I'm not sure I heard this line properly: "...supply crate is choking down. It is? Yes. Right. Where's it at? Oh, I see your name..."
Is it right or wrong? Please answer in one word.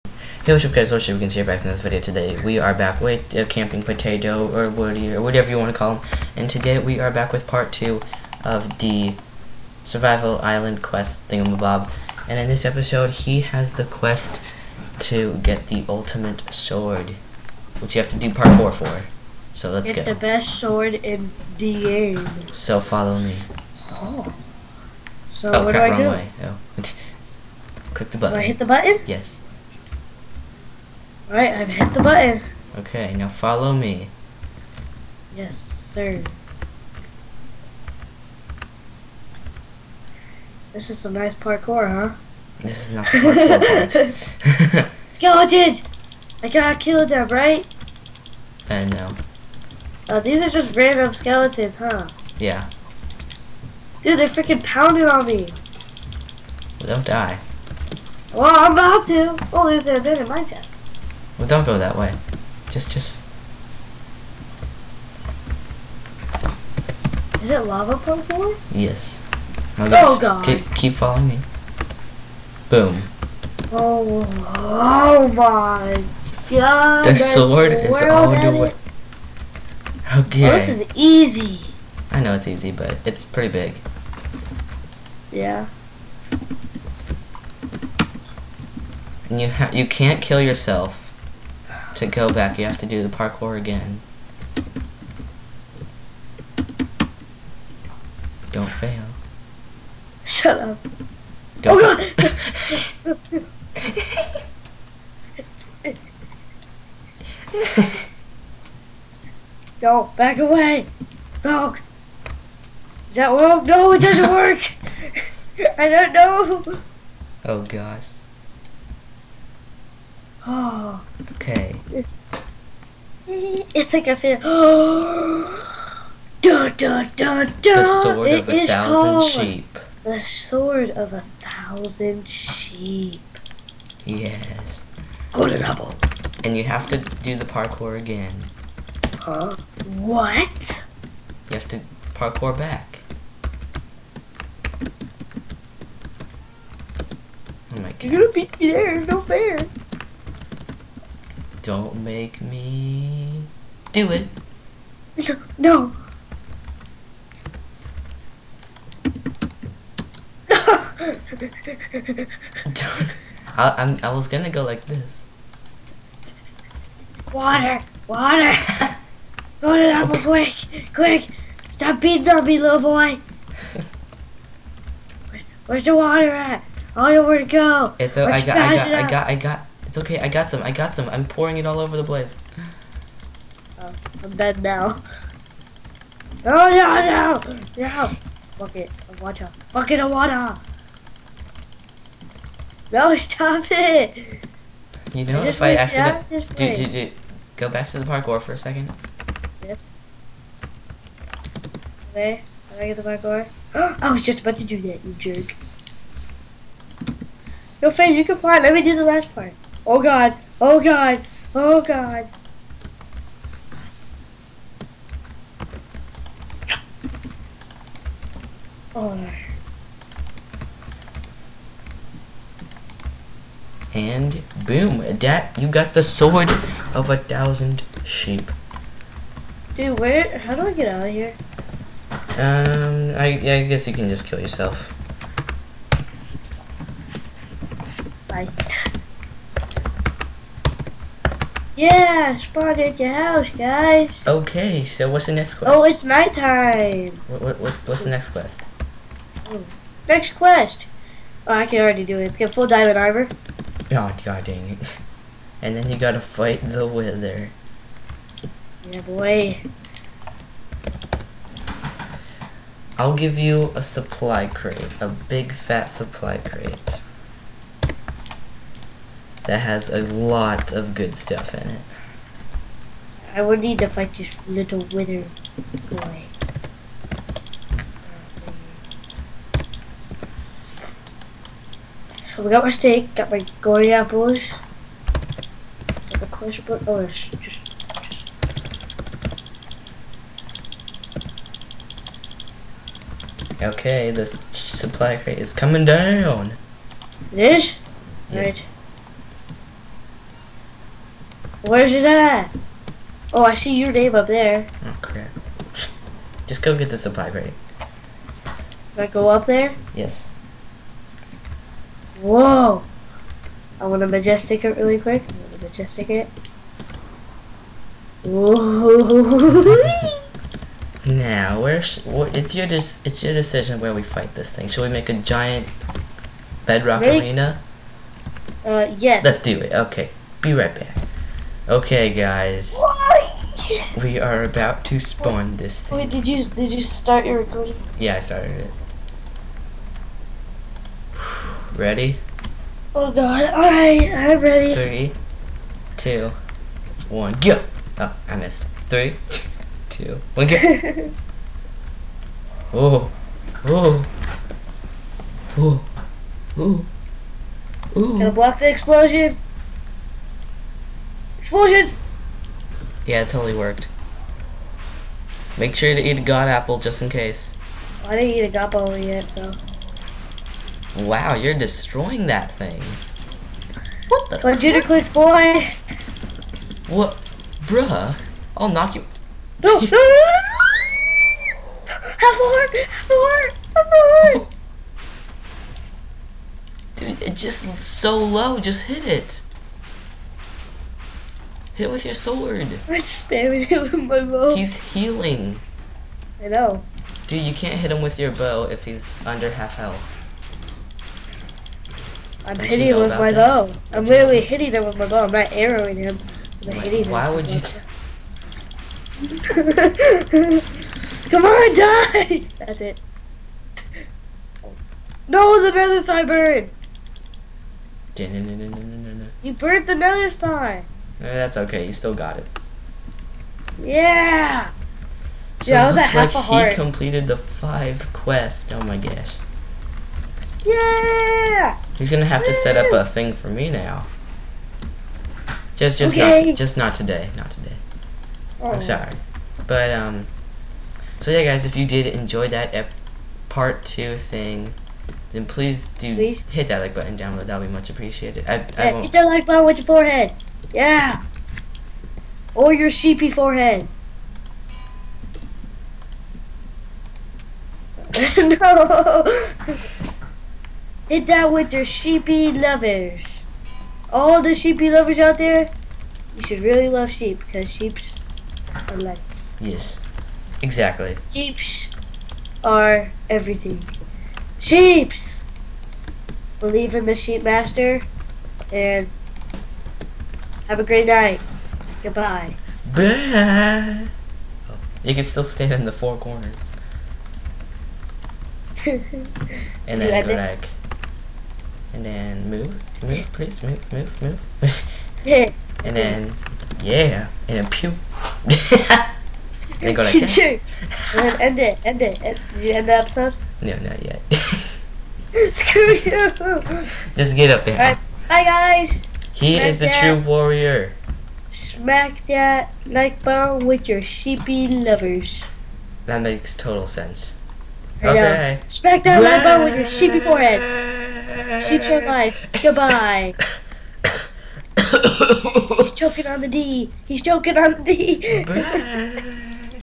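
wrong.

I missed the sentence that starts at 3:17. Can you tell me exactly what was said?
Go back to the parkour for a second.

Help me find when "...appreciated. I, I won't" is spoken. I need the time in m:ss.
7:27.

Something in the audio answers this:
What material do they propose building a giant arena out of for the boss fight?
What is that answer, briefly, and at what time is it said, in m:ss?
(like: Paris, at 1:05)
Bedrock, at 5:26.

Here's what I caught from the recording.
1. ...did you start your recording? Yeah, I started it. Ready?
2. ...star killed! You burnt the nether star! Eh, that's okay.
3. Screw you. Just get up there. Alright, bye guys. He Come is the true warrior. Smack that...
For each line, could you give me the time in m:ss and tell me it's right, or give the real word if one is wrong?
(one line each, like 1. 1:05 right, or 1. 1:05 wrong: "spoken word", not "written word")
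1. 5:36 right
2. 6:56 wrong: "burned", not "killed"
3. 8:25 wrong: "Smack", not "Come".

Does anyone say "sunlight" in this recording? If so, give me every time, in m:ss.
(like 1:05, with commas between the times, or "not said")
not said.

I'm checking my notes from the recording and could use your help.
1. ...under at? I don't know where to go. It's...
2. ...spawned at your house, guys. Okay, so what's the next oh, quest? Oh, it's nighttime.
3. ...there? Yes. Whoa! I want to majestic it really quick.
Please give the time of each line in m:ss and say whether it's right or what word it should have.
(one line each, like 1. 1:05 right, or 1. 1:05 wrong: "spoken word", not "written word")
1. 2:55 wrong: "water", not "under"
2. 4:02 right
3. 5:09 right.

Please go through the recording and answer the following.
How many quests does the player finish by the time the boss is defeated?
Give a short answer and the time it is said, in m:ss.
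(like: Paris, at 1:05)
5, at 7:07.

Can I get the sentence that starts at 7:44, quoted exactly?
All the sheepy lovers out there, you should really love sheep because sheep are life.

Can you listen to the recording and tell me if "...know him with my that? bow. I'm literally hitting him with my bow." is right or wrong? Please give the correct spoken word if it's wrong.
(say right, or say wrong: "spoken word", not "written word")
right.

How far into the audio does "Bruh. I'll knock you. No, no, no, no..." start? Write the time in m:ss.
6:17.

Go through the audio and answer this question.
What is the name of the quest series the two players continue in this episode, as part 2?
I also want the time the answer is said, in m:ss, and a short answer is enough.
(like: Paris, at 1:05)
Survival Island, at 0:09.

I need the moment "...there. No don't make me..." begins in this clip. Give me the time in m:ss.
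2:28.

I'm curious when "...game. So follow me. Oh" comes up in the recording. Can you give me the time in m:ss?
0:21.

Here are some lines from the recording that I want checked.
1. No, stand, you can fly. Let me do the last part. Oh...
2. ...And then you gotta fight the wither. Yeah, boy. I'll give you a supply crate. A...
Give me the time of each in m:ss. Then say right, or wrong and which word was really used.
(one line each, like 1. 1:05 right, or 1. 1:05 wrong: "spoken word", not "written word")
1. 3:27 wrong: "friend", not "stand"
2. 4:15 right.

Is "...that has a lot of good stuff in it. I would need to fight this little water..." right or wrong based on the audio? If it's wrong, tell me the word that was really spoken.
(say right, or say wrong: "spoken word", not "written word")
wrong: "wither", not "water".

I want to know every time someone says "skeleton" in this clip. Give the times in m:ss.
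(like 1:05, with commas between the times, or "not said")
0:45, 0:51.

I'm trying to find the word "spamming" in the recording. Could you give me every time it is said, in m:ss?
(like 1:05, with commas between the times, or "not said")
6:33.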